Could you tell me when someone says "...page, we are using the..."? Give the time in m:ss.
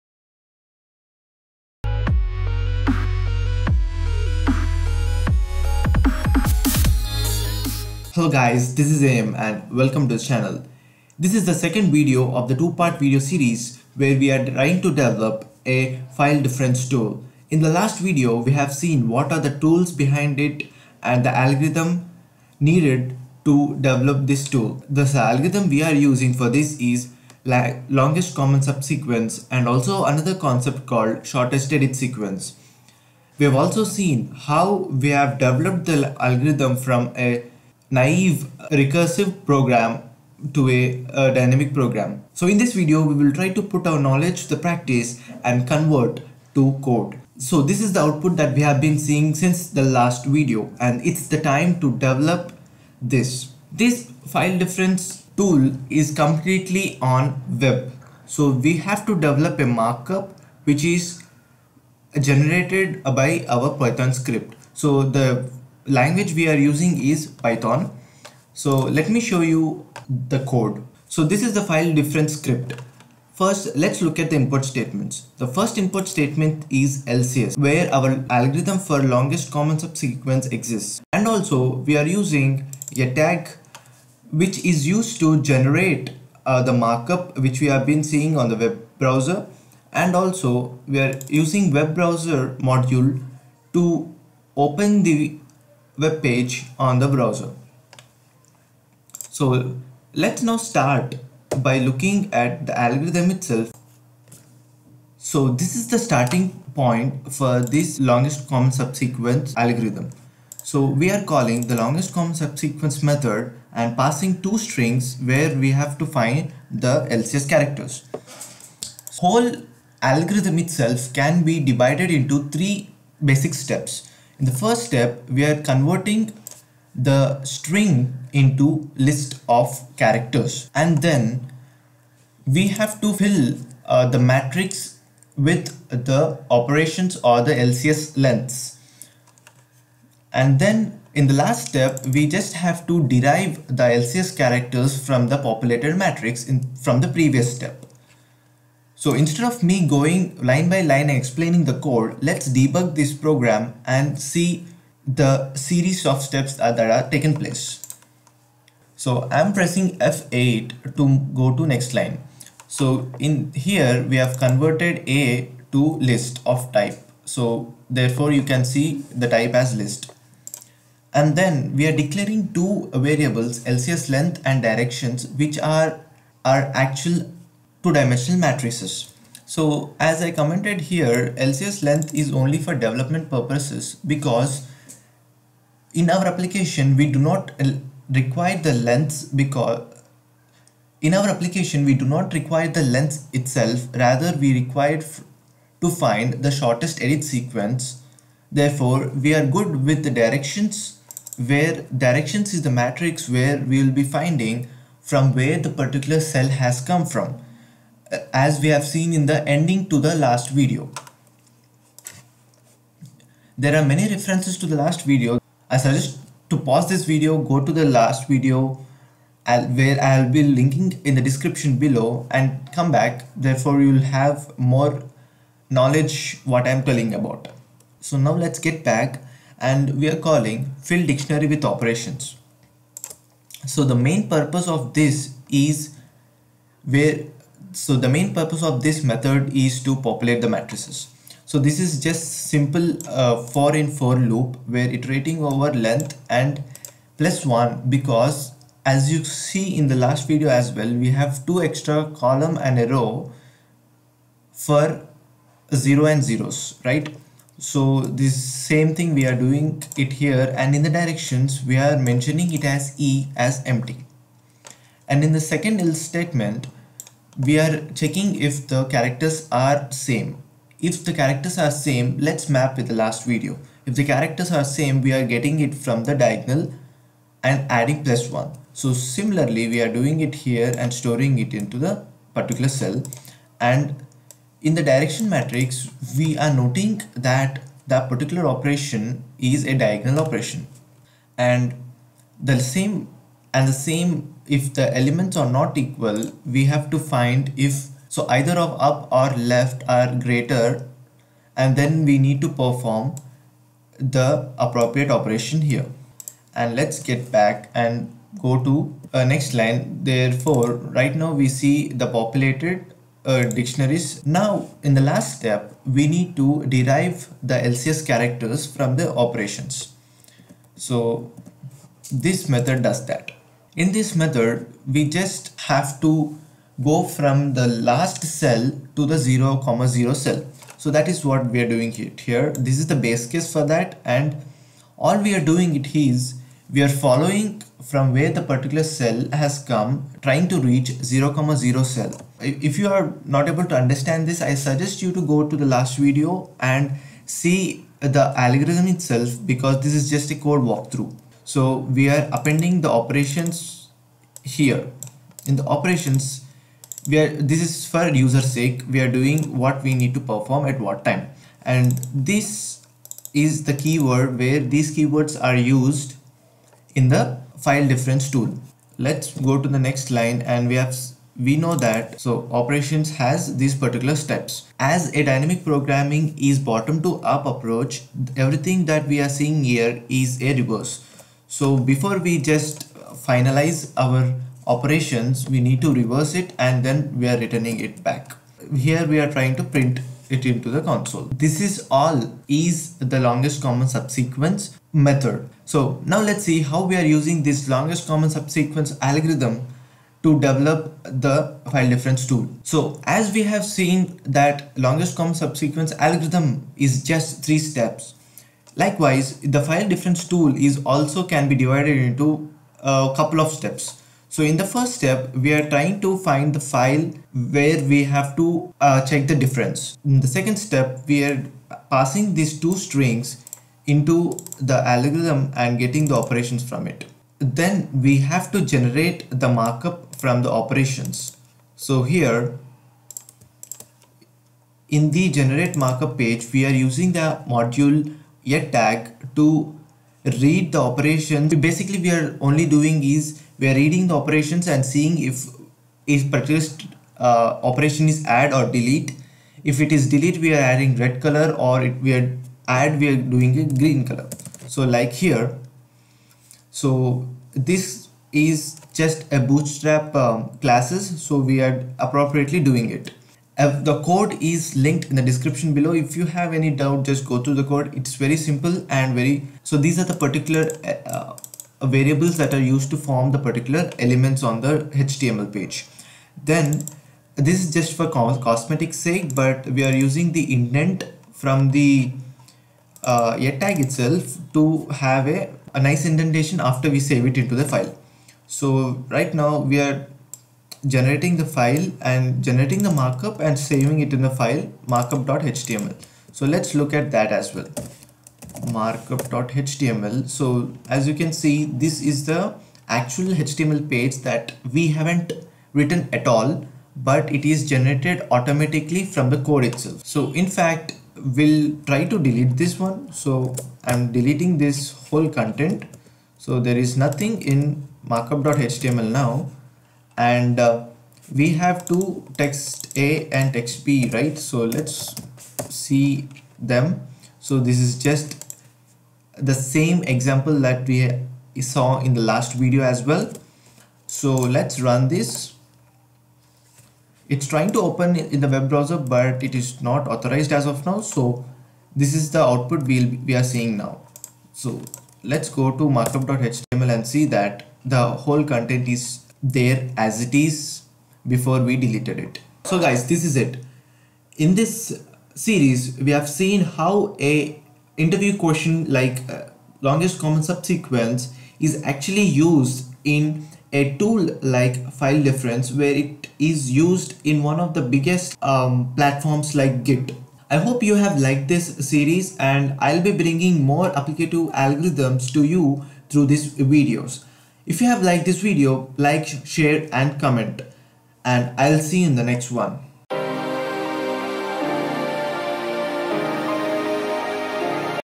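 7:16.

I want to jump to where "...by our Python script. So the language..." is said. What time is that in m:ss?
1:03.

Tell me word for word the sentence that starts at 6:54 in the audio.
So in the first step, we are trying to find the file where we have to uh, check the difference.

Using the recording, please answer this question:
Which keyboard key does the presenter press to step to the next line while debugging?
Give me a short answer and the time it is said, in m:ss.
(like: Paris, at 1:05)
F8, at 2:39.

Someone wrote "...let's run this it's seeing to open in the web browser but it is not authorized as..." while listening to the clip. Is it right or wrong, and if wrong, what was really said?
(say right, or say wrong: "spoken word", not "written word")
wrong: "trying", not "seeing".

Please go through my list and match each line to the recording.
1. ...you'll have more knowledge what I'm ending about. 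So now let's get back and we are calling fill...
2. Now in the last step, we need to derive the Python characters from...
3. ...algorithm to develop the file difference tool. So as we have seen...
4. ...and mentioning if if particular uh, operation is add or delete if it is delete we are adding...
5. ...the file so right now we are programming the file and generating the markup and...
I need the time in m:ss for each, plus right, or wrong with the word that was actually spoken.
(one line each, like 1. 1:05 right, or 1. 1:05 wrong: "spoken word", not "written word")
1. 3:43 wrong: "telling", not "ending"
2. 5:14 wrong: "LCS", not "Python"
3. 6:39 right
4. 7:24 wrong: "seeing", not "mentioning"
5. 8:07 wrong: "generating", not "programming".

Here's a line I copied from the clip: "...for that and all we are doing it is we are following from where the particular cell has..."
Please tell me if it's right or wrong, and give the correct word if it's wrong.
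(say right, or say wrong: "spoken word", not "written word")
right.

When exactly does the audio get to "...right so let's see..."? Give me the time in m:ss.
8:44.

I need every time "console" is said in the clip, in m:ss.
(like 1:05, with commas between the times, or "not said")
6:30.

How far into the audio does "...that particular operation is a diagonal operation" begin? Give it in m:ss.
4:47.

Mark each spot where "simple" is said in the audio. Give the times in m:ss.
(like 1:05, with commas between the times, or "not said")
4:02, 7:48.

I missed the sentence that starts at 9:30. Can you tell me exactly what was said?
I hope you have liked this series and I'll be bringing more applicative algorithms to you through these videos.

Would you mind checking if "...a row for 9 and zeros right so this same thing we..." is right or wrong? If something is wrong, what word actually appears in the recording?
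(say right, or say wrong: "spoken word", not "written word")
wrong: "0", not "9".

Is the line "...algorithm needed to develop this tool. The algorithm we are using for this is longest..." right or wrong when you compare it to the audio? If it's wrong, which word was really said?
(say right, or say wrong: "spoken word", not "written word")
right.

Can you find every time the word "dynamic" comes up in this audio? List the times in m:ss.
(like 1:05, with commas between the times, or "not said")
0:41, 6:15.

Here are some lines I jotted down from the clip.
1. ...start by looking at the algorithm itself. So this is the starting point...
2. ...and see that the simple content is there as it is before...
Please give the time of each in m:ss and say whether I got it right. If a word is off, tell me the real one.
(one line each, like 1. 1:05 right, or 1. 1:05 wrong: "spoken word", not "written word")
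1. 1:40 right
2. 9:06 wrong: "whole", not "simple".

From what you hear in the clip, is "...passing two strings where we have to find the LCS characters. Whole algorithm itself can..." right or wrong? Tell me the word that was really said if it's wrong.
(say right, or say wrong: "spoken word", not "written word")
right.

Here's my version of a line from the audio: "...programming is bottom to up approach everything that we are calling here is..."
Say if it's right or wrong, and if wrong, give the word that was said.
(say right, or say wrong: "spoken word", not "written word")
wrong: "seeing", not "calling".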